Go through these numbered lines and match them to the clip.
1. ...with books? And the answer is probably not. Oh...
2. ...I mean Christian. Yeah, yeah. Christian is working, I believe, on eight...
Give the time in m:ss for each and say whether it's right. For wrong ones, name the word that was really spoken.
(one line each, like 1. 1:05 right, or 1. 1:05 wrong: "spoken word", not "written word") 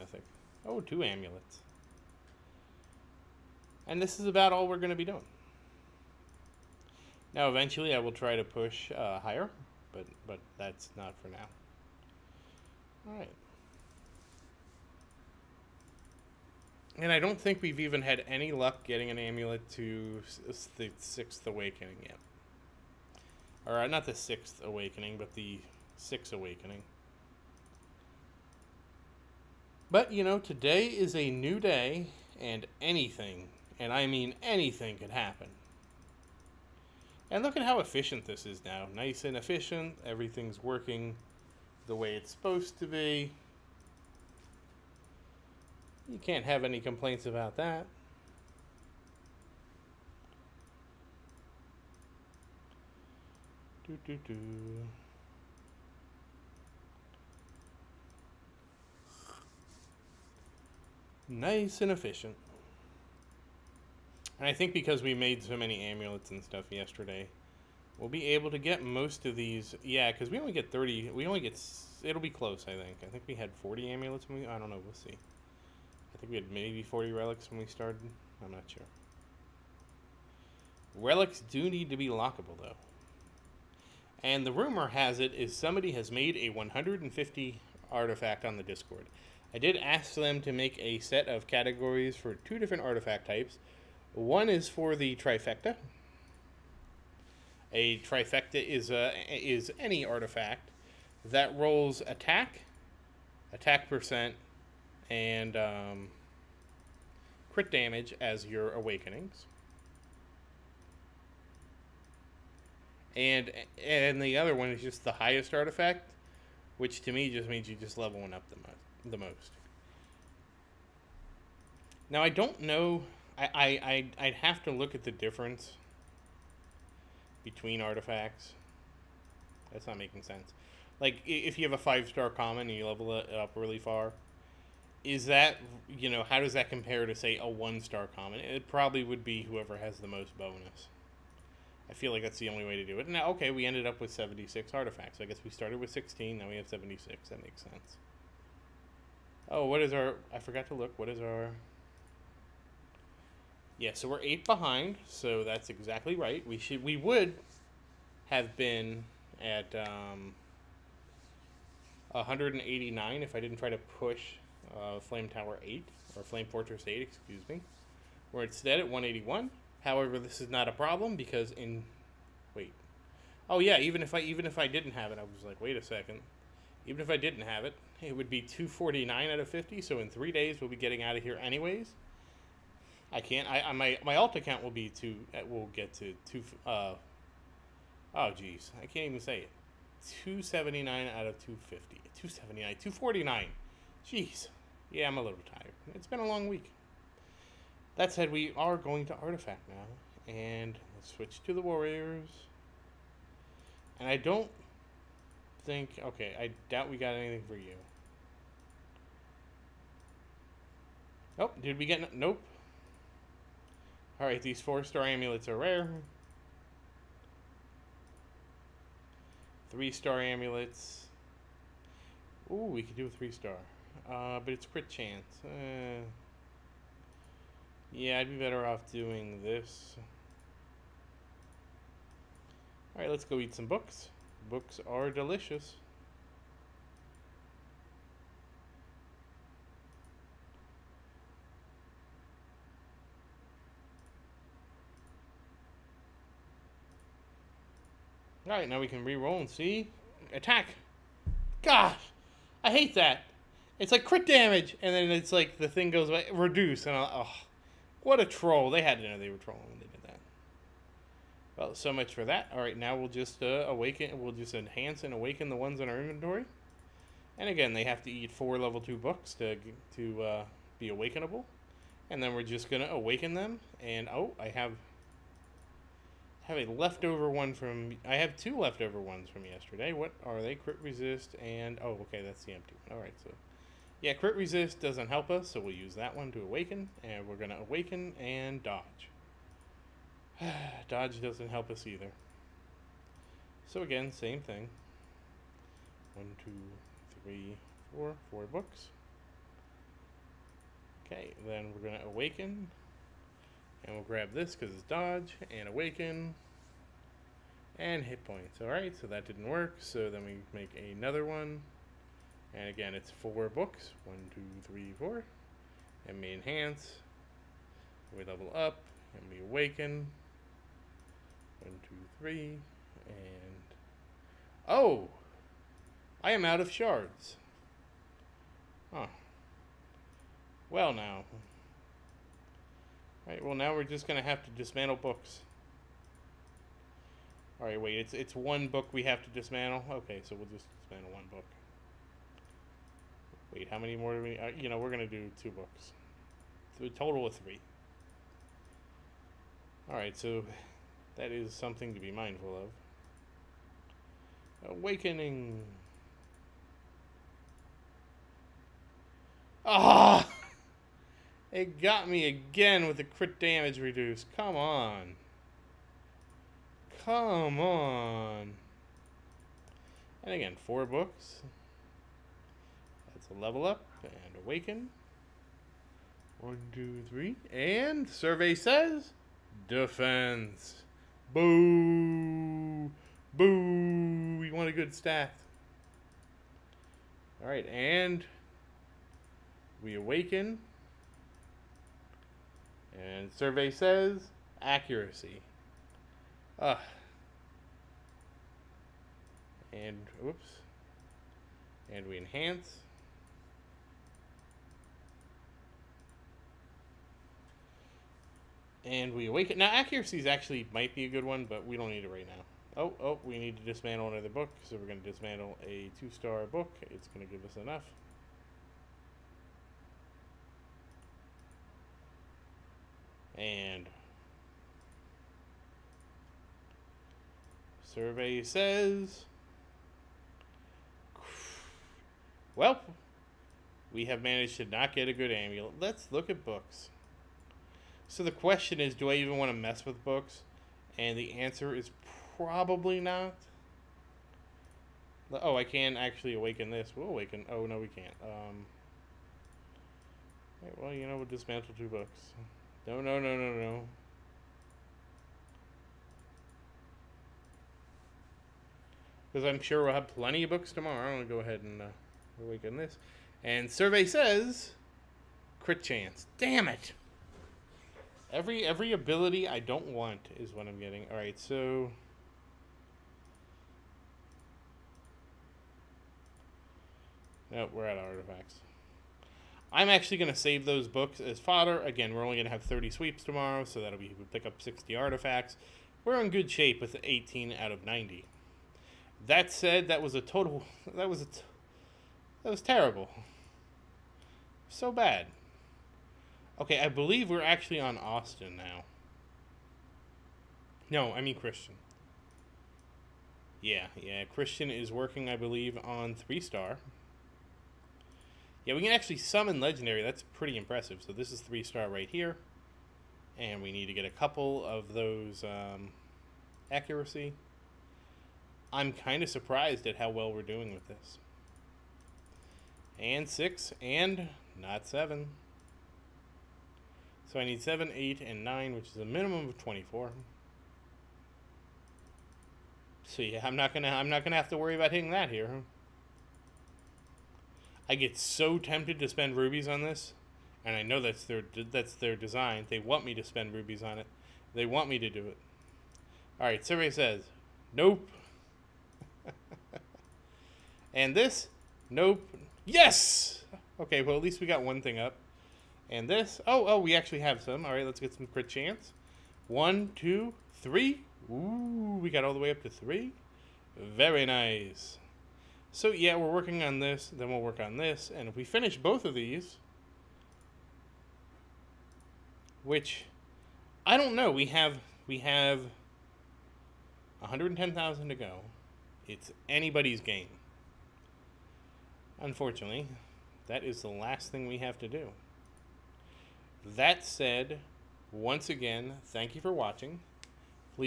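1. 7:19 right
2. 8:21 wrong: "three", not "eight".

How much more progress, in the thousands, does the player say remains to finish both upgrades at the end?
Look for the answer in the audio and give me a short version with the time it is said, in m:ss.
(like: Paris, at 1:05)
110,000, at 9:37.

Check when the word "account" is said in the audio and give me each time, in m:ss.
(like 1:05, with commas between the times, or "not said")
3:04.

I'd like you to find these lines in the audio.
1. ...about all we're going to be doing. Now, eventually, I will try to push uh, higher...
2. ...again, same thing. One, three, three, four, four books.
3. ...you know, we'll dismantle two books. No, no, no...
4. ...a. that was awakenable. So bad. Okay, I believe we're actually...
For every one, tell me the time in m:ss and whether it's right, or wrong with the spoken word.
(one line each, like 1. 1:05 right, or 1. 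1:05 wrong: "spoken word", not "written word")
1. 0:04 right
2. 4:53 wrong: "two", not "three"
3. 7:30 right
4. 8:11 wrong: "terrible", not "awakenable".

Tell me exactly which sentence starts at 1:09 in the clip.
Yeah, because we only get 30.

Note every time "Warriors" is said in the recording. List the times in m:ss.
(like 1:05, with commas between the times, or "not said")
3:21.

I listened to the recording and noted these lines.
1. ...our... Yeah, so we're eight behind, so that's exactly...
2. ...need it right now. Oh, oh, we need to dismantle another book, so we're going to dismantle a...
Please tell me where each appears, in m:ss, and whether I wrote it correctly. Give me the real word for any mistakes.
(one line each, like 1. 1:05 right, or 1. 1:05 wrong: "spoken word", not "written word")
1. 2:31 right
2. 6:51 right.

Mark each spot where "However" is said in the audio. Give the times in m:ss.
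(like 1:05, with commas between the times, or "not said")
2:49.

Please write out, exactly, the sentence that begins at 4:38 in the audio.
I have two leftover ones from yesterday.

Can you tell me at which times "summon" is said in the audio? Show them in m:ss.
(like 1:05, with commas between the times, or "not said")
8:29.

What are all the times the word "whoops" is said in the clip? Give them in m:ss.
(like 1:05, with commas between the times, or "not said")
6:40.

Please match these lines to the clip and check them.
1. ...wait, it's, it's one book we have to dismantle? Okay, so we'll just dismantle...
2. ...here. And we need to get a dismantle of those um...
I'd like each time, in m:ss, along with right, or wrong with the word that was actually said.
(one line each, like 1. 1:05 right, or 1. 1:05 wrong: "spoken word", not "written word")
1. 5:37 right
2. 8:32 wrong: "couple", not "dismantle".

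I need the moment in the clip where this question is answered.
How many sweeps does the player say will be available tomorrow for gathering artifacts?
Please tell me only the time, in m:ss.
8:02.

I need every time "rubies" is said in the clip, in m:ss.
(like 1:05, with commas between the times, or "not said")
8:59, 9:03.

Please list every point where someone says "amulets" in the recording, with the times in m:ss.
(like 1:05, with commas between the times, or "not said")
0:01, 0:19, 1:05, 1:13, 3:35, 3:40, 7:15.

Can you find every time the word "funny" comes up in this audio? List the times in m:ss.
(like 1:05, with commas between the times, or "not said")
not said.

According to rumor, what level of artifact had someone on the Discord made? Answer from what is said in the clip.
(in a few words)
150.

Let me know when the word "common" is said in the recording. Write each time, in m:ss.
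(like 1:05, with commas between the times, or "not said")
2:12, 2:18.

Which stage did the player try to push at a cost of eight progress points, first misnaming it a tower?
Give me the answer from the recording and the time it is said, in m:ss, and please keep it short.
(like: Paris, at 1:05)
Flame Fortress 8, at 2:46.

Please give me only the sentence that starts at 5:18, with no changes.
We level up and we awaken.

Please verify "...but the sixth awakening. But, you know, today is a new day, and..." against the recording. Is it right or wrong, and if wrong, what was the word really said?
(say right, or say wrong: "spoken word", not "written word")
right.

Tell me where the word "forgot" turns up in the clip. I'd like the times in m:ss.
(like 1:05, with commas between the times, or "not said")
2:30.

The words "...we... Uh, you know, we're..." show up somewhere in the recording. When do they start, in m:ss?
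5:44.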